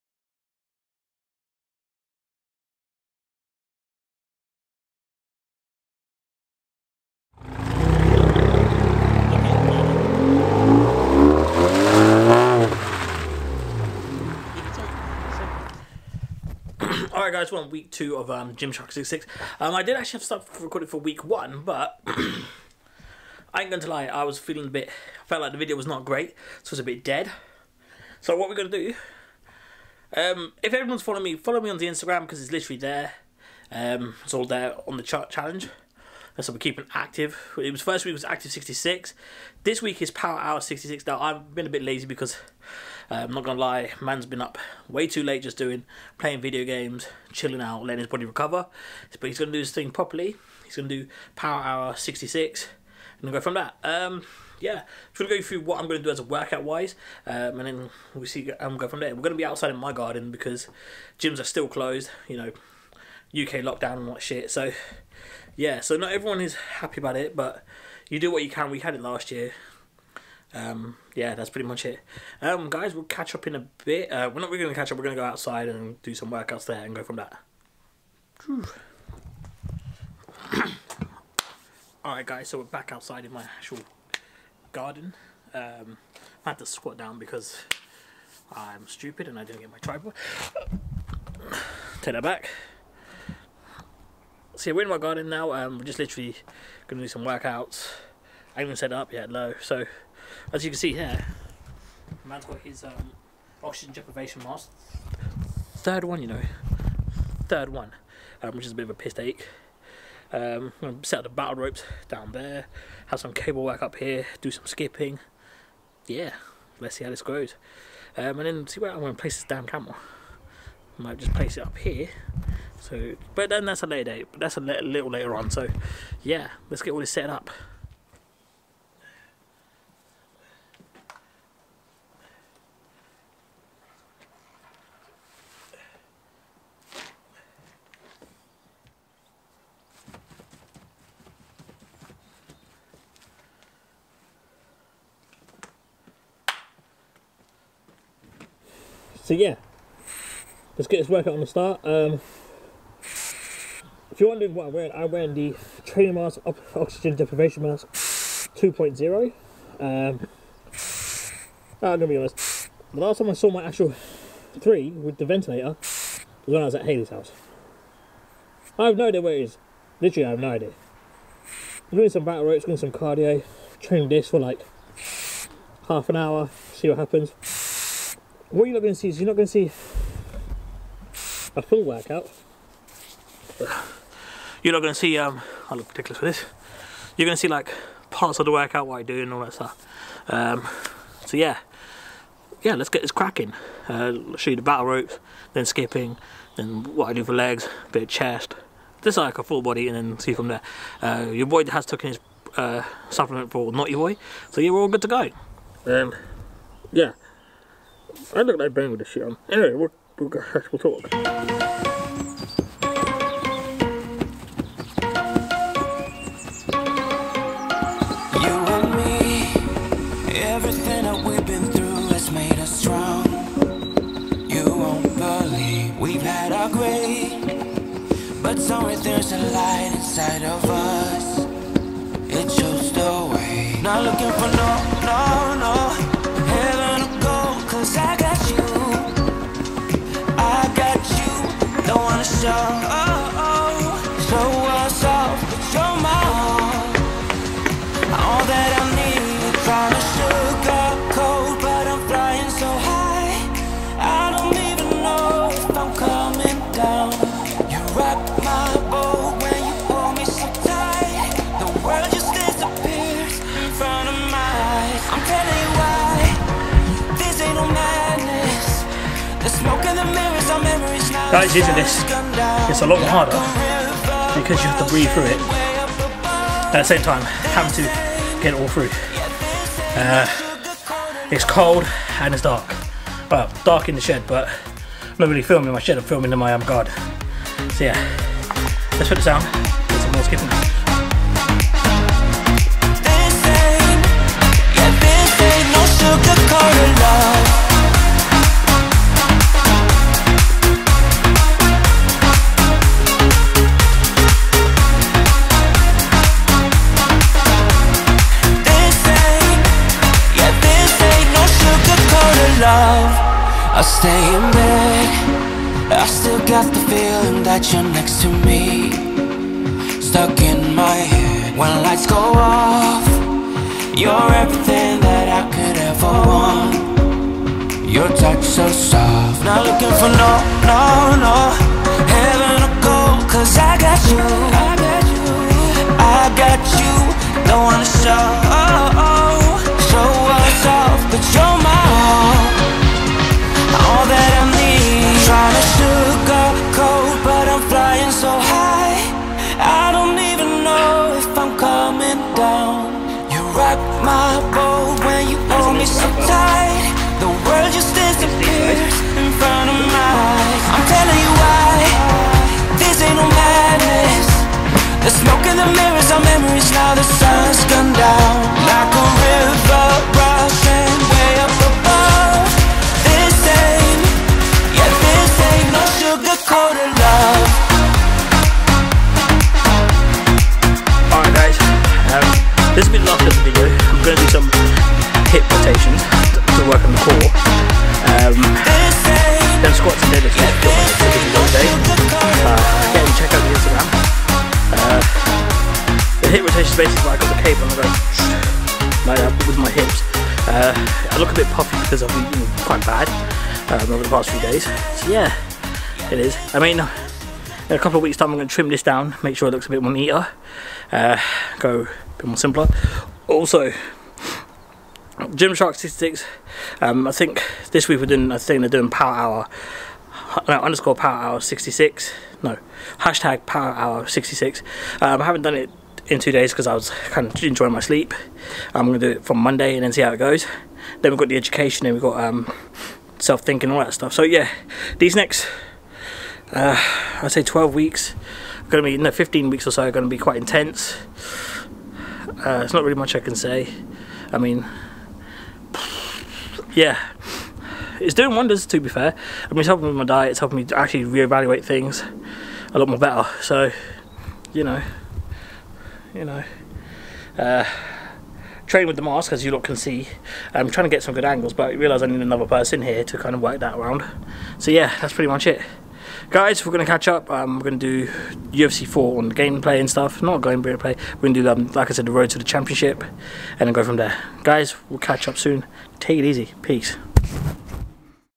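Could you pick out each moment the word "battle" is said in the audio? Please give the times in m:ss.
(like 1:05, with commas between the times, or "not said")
1:51, 2:52, 3:14.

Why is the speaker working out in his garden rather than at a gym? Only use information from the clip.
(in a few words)
UK lockdown.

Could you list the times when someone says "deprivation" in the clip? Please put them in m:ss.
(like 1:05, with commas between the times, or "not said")
1:43, 2:37.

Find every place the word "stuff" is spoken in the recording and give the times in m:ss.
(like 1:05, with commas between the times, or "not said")
0:20, 3:09, 7:13, 7:49.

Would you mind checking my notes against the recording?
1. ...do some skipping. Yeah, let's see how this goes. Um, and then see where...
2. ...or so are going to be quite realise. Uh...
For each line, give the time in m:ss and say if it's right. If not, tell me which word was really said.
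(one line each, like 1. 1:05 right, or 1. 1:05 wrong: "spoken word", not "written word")
1. 1:54 right
2. 7:19 wrong: "intense", not "realise".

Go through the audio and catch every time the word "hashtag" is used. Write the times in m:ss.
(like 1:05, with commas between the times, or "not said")
7:02.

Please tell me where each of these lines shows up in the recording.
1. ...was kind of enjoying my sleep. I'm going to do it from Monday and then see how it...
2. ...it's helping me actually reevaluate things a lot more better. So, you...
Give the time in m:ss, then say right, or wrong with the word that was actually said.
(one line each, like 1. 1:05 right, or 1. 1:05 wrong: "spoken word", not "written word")
1. 7:06 right
2. 7:30 right.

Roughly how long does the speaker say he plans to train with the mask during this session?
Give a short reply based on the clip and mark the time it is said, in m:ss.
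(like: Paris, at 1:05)
half an hour, at 2:55.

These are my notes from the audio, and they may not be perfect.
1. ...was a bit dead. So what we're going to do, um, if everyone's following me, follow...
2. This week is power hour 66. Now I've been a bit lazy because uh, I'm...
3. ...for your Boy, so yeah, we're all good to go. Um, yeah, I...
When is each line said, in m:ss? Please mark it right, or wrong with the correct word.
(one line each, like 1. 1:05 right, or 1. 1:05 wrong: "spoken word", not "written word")
1. 0:26 right
2. 0:39 right
3. 3:23 right.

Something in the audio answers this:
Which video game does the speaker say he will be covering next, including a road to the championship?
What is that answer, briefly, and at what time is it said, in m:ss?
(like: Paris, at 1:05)
UFC 4, at 7:48.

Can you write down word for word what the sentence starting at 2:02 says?
So, but then that's a later date.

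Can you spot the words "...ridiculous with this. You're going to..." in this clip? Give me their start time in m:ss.
3:05.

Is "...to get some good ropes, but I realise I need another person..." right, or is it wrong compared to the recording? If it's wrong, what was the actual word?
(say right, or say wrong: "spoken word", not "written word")
wrong: "angles", not "ropes".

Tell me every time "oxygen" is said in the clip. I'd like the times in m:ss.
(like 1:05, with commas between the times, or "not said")
1:43, 2:36.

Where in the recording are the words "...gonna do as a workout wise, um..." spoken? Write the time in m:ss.
0:55.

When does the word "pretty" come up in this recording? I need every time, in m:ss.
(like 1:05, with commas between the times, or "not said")
1:11, 7:45.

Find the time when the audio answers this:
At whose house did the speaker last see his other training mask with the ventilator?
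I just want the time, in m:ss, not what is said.
2:46.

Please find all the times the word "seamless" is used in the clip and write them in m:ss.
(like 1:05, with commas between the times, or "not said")
not said.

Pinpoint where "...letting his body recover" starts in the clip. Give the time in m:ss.
0:47.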